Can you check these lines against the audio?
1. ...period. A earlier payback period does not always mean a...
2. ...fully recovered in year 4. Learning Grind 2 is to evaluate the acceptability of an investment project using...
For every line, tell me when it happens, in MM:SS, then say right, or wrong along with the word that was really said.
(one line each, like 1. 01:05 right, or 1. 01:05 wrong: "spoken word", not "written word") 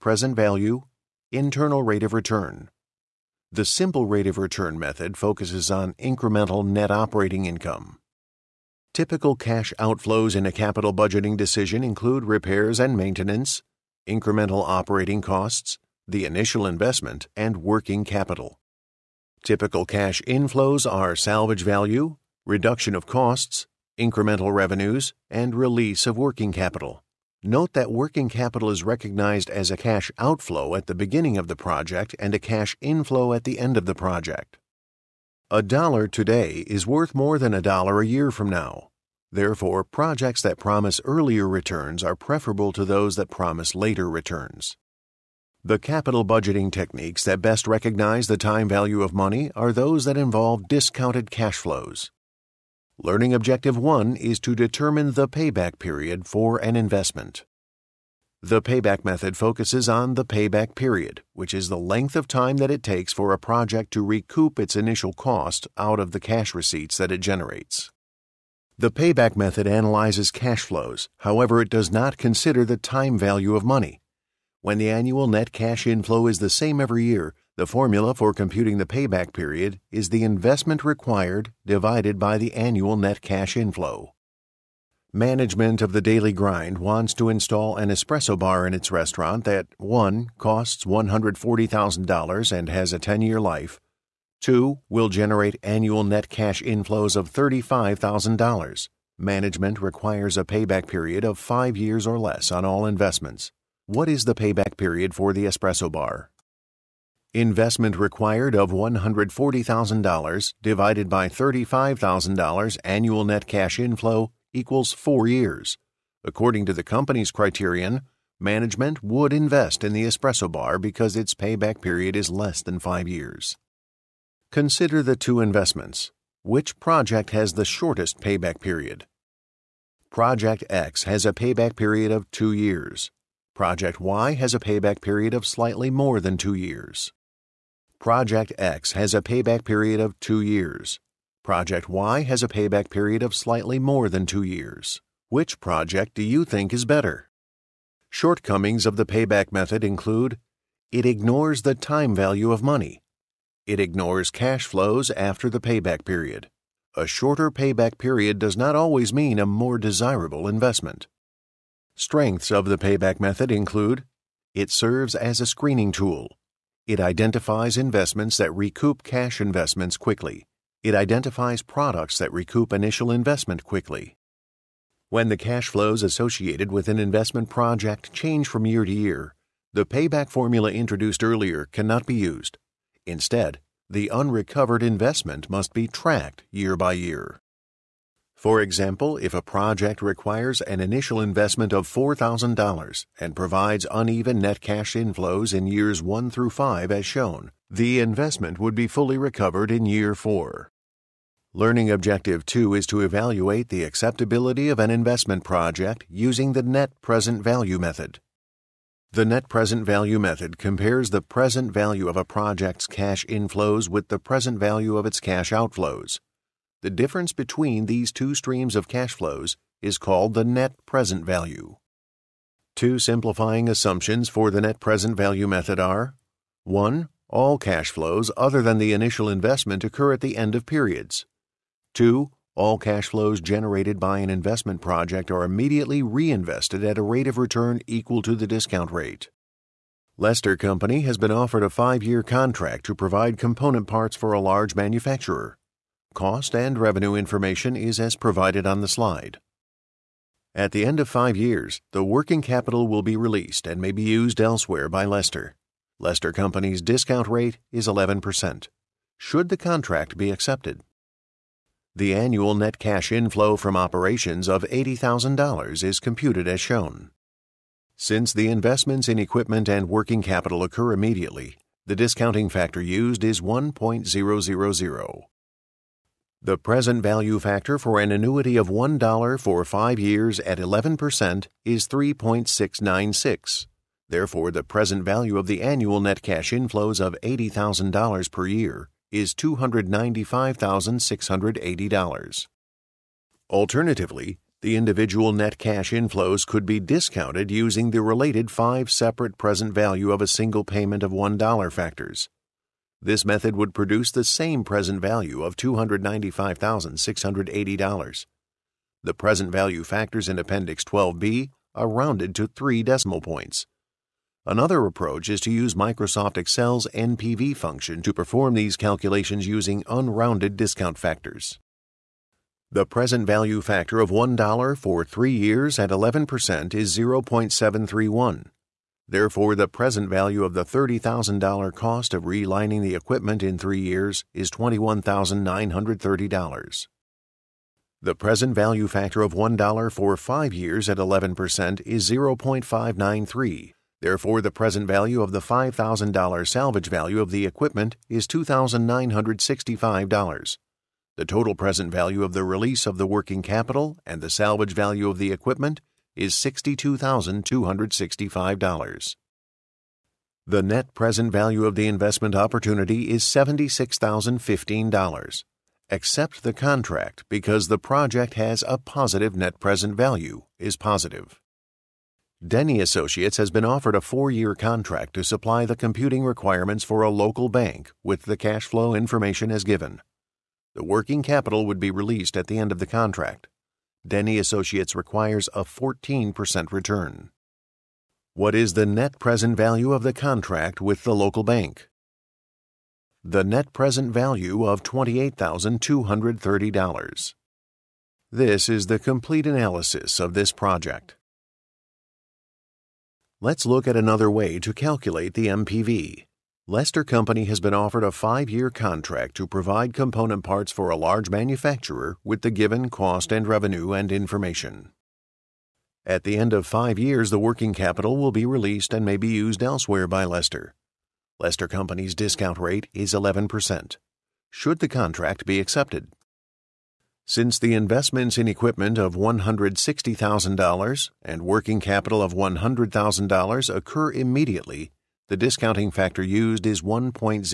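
1. 02:36 wrong: "shorter", not "earlier"
2. 03:18 wrong: "Objective", not "Grind".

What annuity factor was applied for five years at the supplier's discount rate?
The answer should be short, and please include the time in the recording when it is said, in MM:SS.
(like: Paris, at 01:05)
3.696, at 04:41.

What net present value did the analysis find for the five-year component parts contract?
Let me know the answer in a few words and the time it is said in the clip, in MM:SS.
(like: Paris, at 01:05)
$76,015, at 06:03.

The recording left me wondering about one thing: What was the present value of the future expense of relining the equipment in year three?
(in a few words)
$21,930.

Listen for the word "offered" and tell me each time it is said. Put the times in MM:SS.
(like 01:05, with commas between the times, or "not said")
04:01, 06:13, 06:47.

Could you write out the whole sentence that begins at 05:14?
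Another approach is to use Microsoft Excel's NPV function to perform these calculations using unrounded discount factors.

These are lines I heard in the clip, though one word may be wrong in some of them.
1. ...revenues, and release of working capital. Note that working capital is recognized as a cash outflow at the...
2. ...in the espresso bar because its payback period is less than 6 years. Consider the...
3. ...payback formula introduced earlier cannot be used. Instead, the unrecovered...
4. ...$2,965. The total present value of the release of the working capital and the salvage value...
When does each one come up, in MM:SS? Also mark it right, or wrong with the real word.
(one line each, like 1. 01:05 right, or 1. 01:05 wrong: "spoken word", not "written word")
1. 00:24 right
2. 01:59 wrong: "5", not "6"
3. 02:59 right
4. 05:48 right.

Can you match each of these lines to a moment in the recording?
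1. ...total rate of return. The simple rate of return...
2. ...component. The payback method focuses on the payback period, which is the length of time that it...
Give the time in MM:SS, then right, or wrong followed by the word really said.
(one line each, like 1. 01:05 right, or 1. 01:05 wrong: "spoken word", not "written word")
1. 00:01 wrong: "internal", not "total"
2. 00:56 wrong: "investment", not "component".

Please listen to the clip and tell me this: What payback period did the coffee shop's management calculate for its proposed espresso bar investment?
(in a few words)
4 years.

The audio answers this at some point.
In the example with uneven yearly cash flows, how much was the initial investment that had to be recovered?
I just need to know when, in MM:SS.
03:11.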